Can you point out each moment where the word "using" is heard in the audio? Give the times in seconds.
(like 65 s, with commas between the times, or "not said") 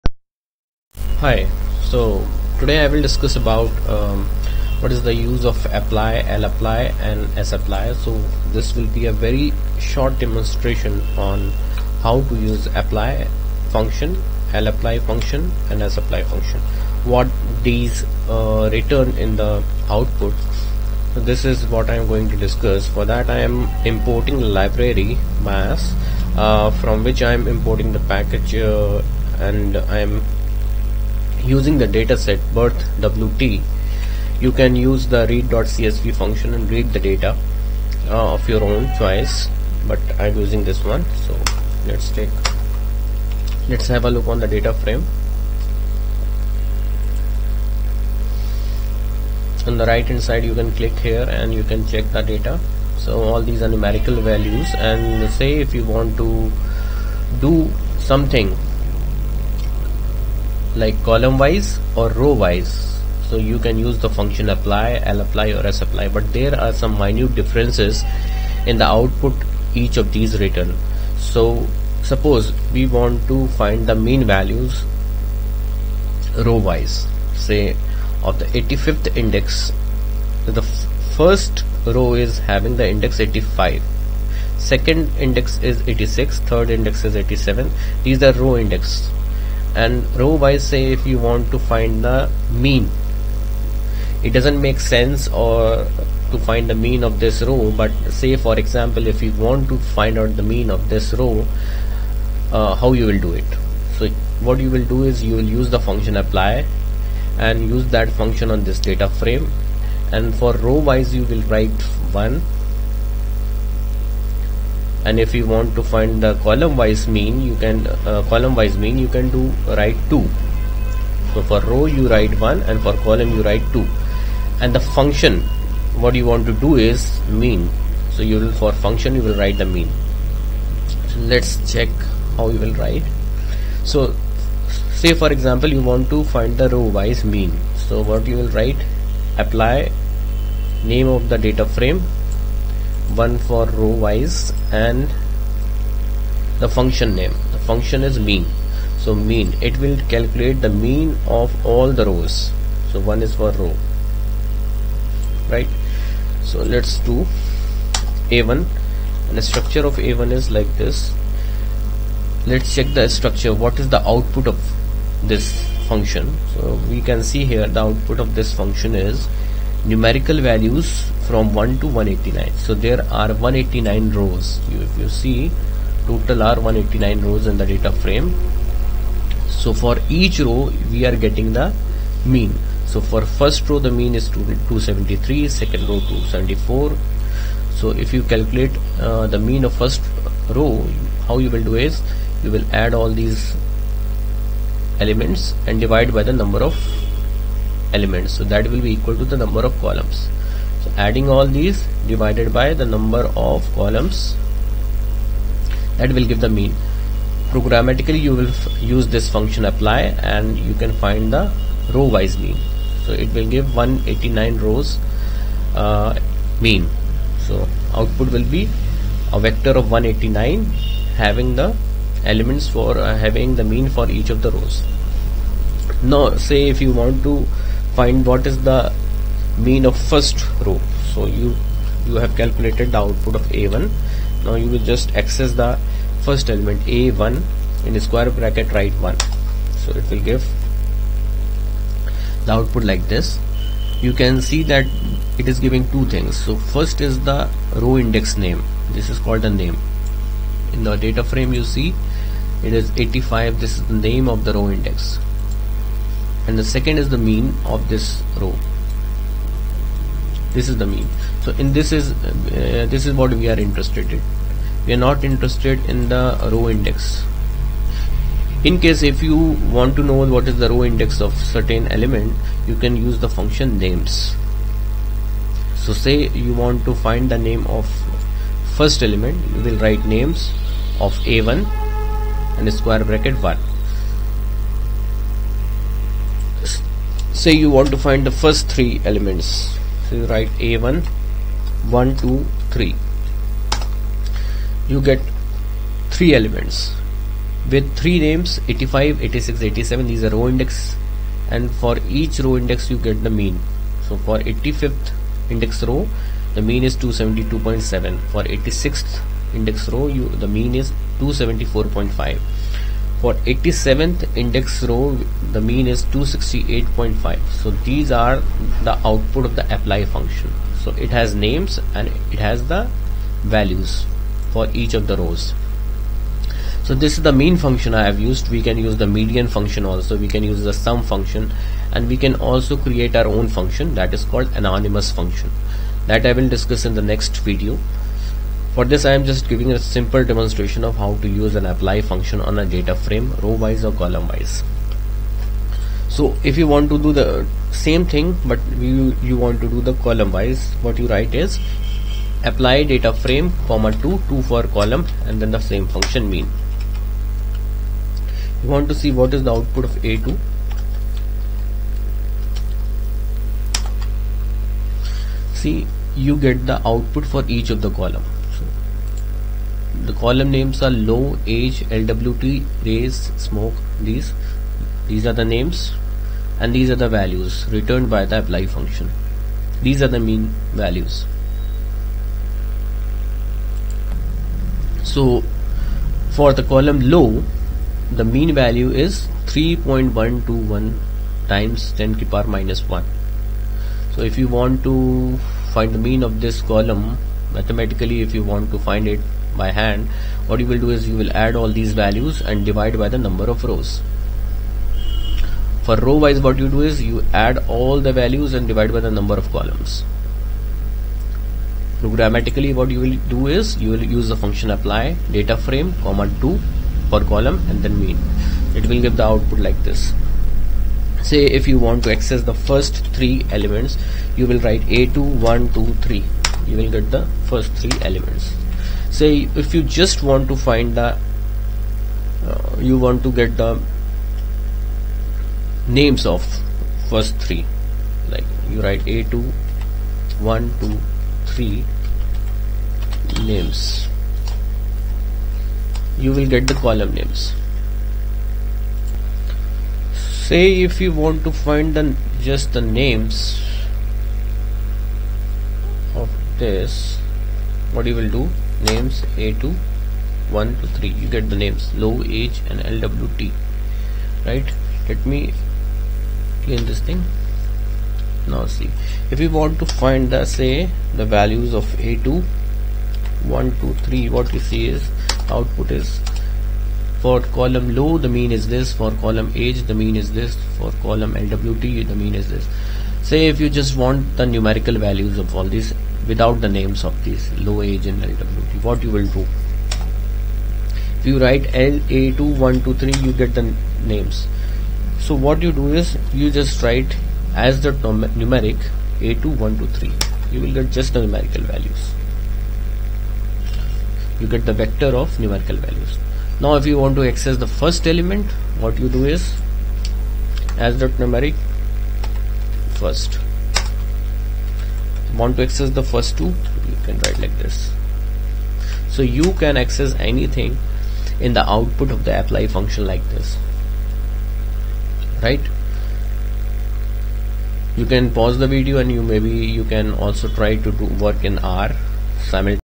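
31 s, 40 s.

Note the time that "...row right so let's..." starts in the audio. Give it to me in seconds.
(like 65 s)
153 s.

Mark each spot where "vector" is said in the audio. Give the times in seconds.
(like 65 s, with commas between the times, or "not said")
219 s, 504 s.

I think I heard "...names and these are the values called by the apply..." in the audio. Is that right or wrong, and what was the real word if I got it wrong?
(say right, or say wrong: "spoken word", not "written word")
wrong: "returned", not "called".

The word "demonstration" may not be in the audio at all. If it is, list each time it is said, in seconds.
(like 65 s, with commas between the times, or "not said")
10 s, 340 s.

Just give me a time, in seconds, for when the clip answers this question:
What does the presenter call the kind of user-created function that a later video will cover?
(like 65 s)
334 s.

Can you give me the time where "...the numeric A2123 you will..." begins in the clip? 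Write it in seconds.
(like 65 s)
497 s.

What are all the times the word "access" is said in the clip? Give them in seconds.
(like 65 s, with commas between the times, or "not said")
235 s, 422 s, 507 s, 515 s, 519 s.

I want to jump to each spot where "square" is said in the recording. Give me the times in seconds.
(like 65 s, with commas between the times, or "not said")
237 s, 282 s.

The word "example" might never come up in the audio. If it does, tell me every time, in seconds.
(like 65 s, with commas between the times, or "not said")
98 s, 135 s.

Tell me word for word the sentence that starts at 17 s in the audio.
What these uh, return in the output.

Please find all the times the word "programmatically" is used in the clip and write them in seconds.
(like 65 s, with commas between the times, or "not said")
207 s, 412 s.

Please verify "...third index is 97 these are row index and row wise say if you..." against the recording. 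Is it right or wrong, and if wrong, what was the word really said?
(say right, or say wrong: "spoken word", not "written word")
wrong: "87", not "97".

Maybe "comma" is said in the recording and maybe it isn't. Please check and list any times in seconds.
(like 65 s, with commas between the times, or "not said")
353 s, 416 s.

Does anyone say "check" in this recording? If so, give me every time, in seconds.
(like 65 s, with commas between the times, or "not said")
51 s, 131 s, 162 s.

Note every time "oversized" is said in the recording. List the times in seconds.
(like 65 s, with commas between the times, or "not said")
not said.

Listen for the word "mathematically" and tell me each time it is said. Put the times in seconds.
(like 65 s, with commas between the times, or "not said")
397 s.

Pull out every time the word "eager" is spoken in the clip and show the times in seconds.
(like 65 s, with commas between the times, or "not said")
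not said.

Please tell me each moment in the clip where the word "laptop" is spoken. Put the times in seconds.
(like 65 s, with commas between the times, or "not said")
not said.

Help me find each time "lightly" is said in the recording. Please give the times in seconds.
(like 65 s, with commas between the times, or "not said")
not said.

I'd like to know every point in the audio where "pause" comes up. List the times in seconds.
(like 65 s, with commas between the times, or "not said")
528 s.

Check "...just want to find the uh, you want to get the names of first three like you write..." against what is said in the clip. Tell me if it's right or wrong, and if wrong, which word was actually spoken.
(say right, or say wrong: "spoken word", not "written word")
right.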